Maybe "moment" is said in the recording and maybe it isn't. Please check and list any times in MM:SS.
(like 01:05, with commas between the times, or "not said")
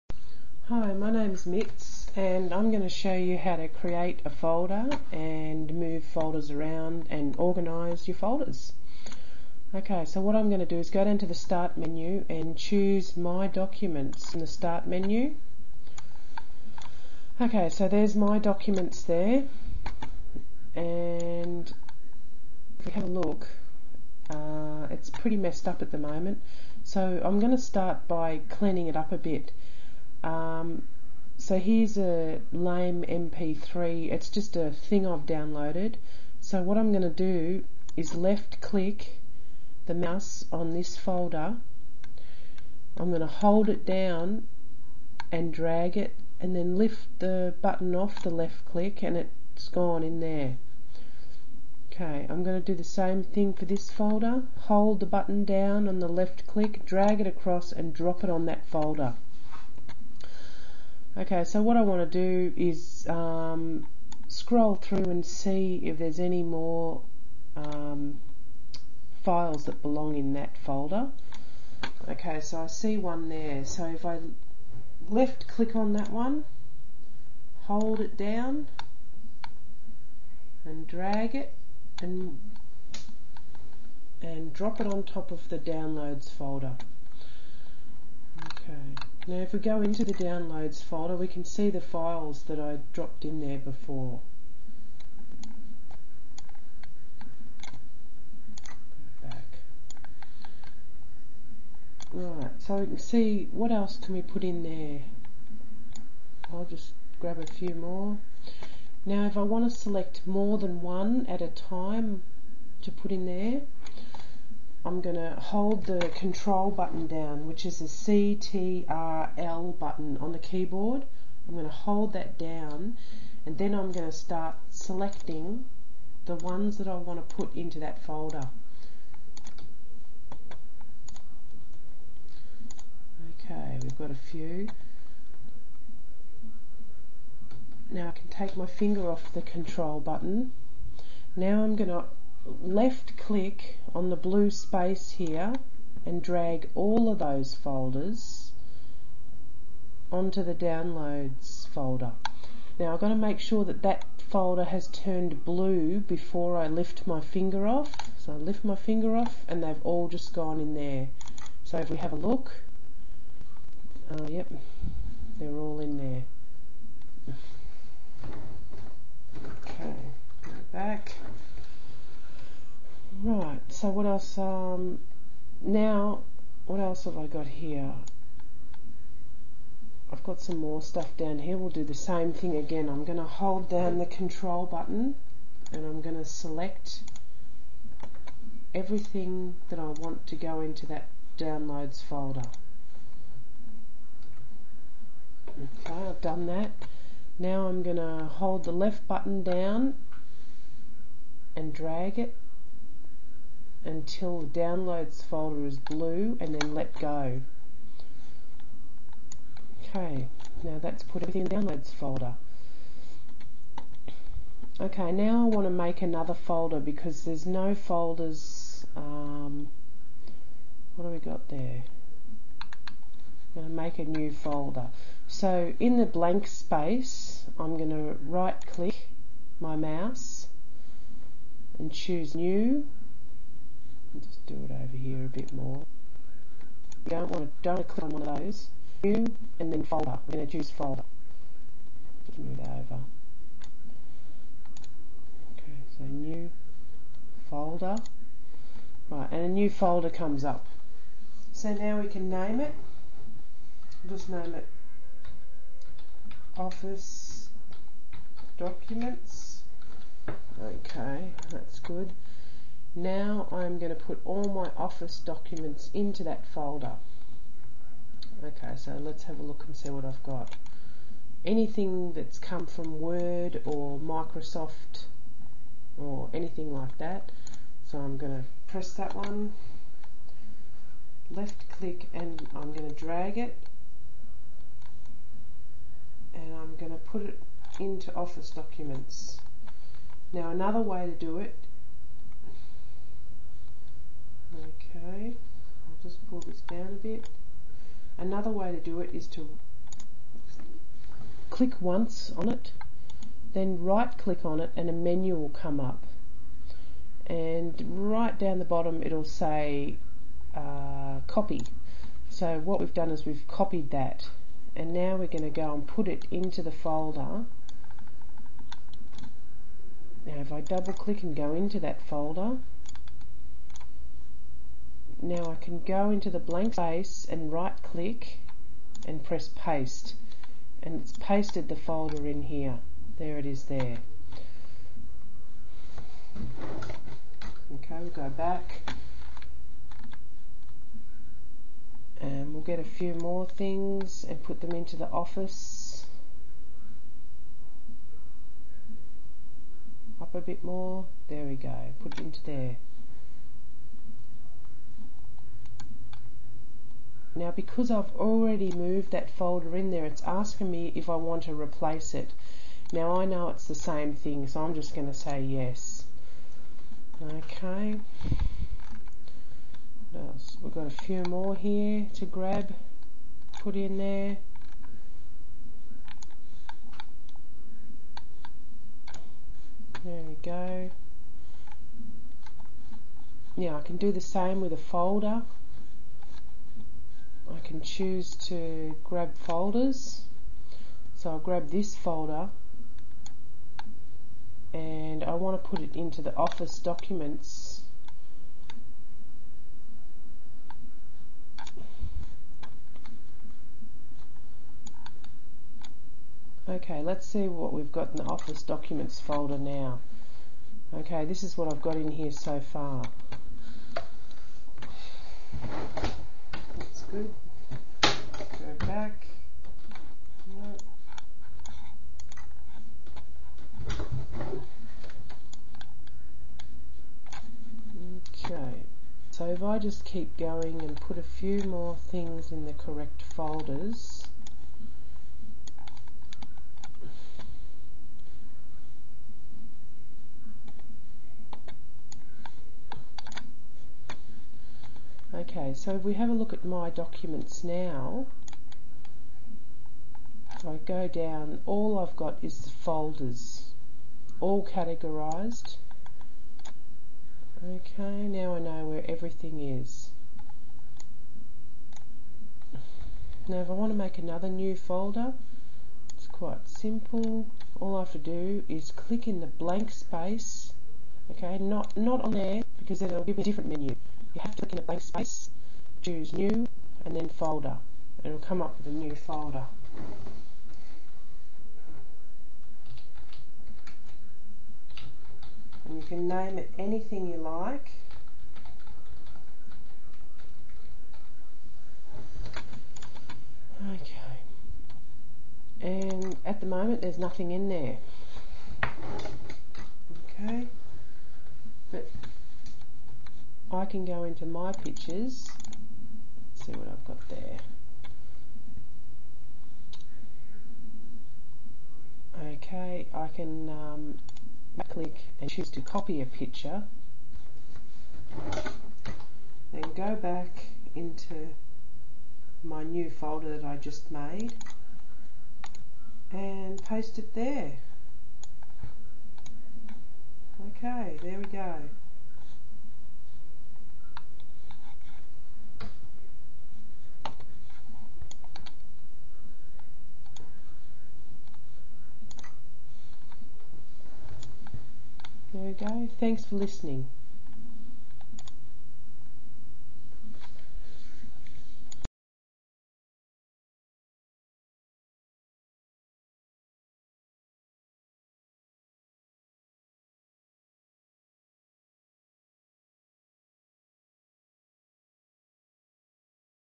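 00:25, 08:16.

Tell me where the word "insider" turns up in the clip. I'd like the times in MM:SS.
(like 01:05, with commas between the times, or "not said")
not said.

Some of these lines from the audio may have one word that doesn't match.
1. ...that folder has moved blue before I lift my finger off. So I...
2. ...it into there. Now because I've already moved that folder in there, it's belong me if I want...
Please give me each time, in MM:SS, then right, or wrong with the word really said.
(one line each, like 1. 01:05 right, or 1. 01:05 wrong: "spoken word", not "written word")
1. 02:33 wrong: "turned", not "moved"
2. 05:52 wrong: "asking", not "belong".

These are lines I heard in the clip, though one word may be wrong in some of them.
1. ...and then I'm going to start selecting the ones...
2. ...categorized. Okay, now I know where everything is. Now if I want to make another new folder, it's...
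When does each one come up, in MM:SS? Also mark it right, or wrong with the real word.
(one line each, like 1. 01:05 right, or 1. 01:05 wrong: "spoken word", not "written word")
1. 02:03 right
2. 07:34 right.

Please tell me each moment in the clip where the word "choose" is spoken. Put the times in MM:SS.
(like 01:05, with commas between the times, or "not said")
00:12, 03:51, 04:00, 06:27, 07:56, 08:35.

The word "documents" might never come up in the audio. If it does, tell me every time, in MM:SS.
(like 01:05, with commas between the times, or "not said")
00:13, 00:18, 04:18, 04:25, 04:48, 06:36, 06:48, 07:26.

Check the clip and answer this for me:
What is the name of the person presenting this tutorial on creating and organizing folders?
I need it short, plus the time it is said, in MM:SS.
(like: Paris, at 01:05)
Mitz, at 00:01.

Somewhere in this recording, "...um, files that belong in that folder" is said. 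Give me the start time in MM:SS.
01:07.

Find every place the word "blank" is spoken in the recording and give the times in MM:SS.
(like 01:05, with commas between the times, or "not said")
03:46, 05:26, 07:49, 07:54.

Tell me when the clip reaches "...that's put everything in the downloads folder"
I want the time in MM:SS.
03:30.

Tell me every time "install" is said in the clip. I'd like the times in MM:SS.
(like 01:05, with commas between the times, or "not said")
not said.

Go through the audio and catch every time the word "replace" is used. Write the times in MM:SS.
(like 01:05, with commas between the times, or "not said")
06:01.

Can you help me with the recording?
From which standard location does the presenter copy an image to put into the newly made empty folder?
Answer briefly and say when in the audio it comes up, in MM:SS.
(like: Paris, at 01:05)
My Pictures, at 08:24.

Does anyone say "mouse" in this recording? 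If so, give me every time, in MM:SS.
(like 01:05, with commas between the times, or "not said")
00:39, 03:49.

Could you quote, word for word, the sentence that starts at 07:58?
it'll come up with a new folder.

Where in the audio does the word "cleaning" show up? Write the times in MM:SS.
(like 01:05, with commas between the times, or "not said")
00:28.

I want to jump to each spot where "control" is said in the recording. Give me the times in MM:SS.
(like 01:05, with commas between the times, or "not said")
01:56, 02:19, 03:04.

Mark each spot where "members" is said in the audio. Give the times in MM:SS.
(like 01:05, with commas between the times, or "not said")
not said.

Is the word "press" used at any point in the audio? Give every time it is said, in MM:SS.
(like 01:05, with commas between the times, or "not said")
04:38, 05:29.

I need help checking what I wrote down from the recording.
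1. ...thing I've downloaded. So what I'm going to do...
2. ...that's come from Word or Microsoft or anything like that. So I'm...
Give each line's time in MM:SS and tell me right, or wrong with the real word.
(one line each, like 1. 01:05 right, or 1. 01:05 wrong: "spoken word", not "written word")
1. 00:34 right
2. 04:32 right.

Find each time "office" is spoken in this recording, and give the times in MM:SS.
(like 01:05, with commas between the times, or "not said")
04:16, 04:24, 04:48, 05:45, 06:36, 06:48.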